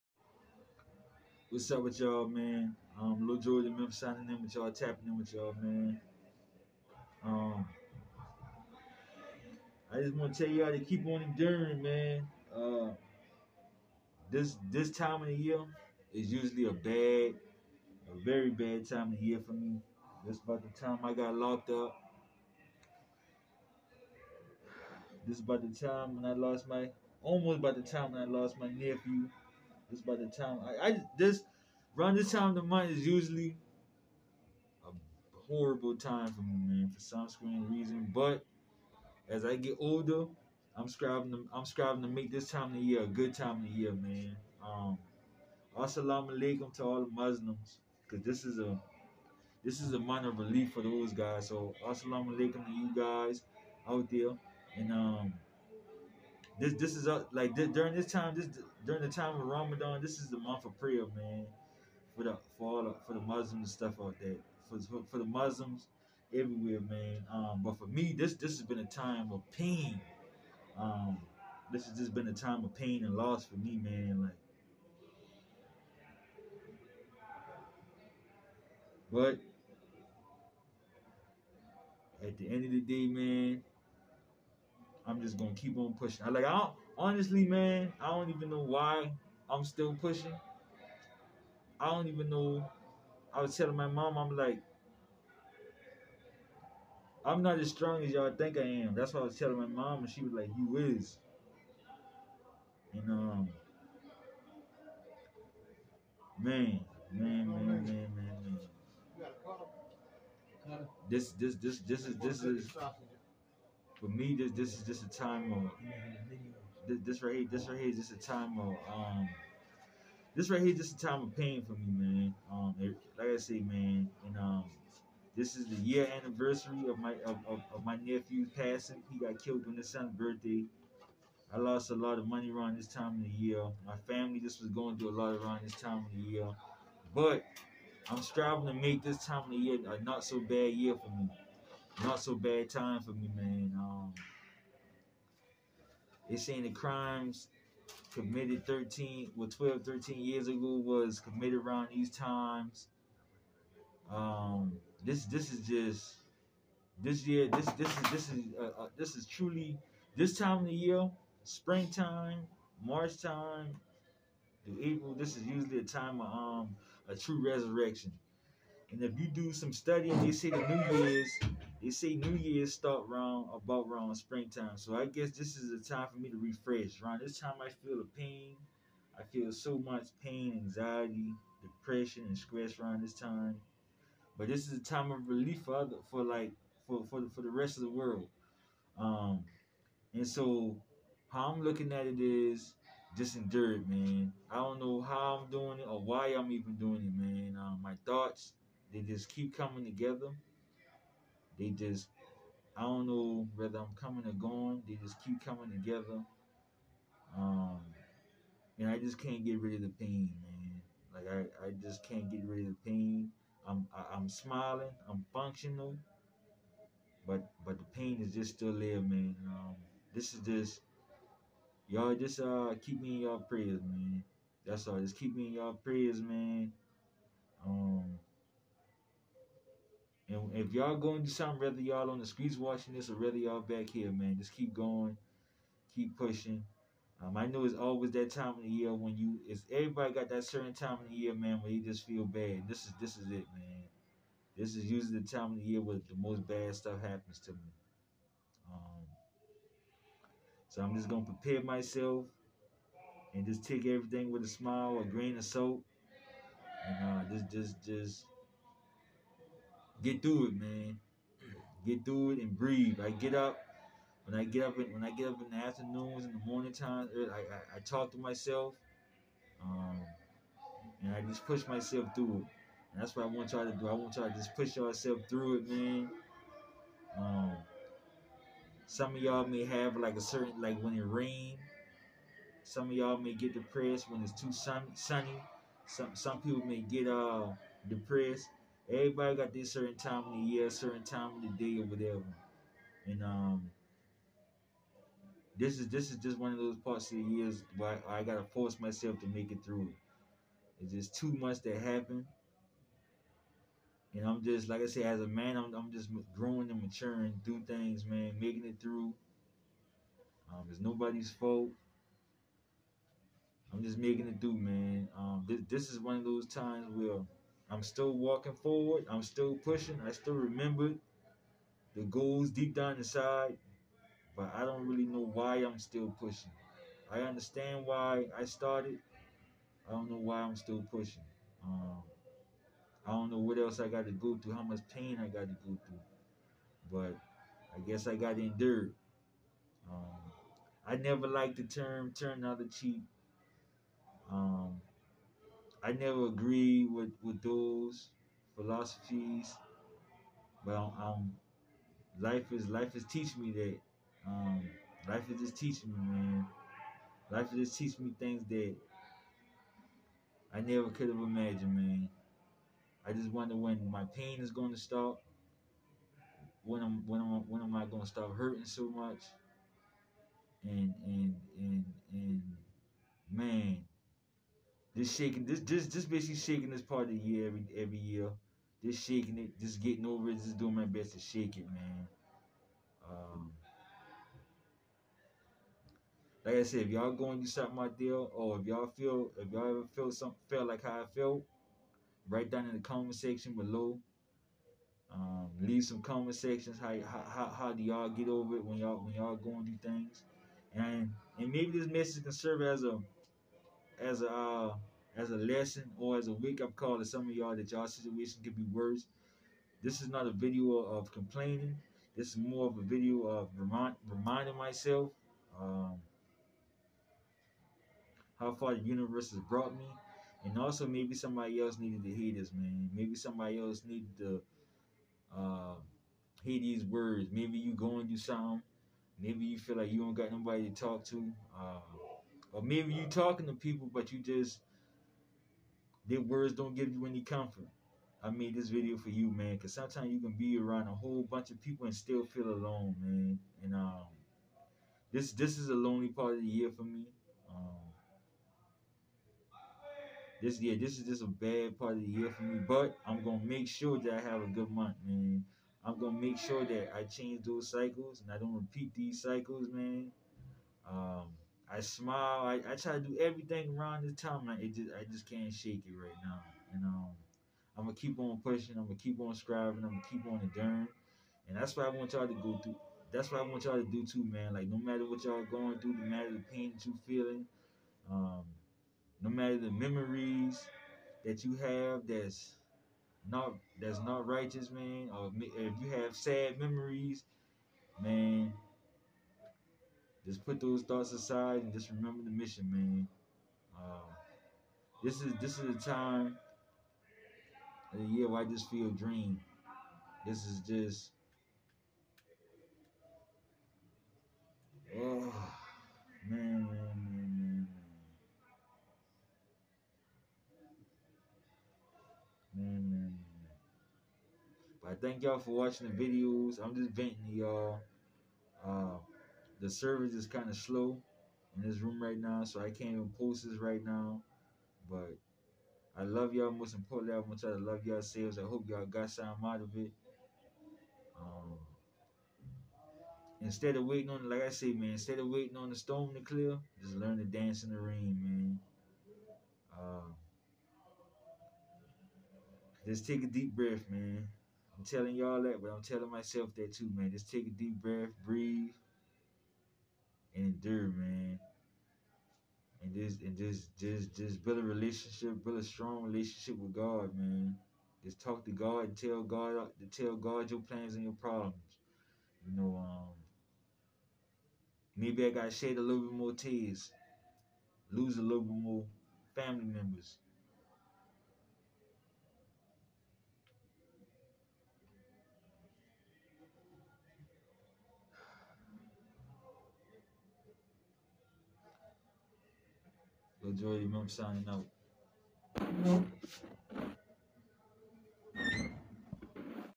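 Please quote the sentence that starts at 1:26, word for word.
I like I don't honestly, man, I don't even know why I'm still pushing.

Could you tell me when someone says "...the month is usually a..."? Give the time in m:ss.
0:32.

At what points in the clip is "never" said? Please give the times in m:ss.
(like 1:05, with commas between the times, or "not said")
5:40, 5:45, 6:00.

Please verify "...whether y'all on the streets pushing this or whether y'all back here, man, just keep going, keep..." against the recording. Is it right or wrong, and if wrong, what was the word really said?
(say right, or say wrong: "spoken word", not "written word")
wrong: "watching", not "pushing".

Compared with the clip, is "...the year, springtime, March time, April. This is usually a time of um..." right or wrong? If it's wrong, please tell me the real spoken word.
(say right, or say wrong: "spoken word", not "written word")
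right.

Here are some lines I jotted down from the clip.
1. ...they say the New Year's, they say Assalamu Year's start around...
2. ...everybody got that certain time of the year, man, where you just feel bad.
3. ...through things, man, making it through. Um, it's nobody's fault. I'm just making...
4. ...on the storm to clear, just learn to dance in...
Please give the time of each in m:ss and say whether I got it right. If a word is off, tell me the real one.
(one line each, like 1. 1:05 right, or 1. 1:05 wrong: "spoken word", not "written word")
1. 2:50 wrong: "New", not "Assalamu"
2. 3:59 right
3. 5:07 right
4. 8:55 right.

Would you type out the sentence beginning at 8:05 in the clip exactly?
Or if you have sad memories, man, just put those thoughts aside and just remember the mission, man.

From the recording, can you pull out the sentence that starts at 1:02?
For the for all the, for the Muslims stuff out there, for for the Muslims everywhere, man.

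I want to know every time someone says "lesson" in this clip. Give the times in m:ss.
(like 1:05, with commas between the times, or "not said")
6:45.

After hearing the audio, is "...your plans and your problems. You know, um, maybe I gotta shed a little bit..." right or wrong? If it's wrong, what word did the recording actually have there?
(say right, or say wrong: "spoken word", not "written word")
right.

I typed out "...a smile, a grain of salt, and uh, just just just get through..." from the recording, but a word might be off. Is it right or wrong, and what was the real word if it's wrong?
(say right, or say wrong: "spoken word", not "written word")
right.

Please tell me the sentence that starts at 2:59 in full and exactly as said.
I feel so much pain, anxiety, depression, and stress around this time.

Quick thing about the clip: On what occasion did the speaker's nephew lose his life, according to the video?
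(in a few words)
His son's birthday.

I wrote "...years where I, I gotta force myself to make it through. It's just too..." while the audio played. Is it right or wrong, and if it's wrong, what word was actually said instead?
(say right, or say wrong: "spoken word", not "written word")
right.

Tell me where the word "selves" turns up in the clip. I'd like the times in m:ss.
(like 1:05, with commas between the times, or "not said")
8:48.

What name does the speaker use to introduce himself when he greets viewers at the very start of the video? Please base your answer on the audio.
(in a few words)
Lil Jordan Memphis.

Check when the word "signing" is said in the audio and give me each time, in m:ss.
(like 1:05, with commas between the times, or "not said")
0:03, 9:44.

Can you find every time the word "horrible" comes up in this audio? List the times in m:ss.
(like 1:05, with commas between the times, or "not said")
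0:35.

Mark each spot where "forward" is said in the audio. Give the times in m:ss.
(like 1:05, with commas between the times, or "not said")
5:18.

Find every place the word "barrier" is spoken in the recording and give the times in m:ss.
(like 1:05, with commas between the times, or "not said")
not said.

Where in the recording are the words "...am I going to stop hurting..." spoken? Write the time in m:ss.
6:07.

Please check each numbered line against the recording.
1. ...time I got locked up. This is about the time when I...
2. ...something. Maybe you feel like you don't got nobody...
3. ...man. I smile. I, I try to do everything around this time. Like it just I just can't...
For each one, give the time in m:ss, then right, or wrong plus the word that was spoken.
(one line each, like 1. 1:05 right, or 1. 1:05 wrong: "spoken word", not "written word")
1. 0:20 right
2. 7:08 right
3. 7:39 right.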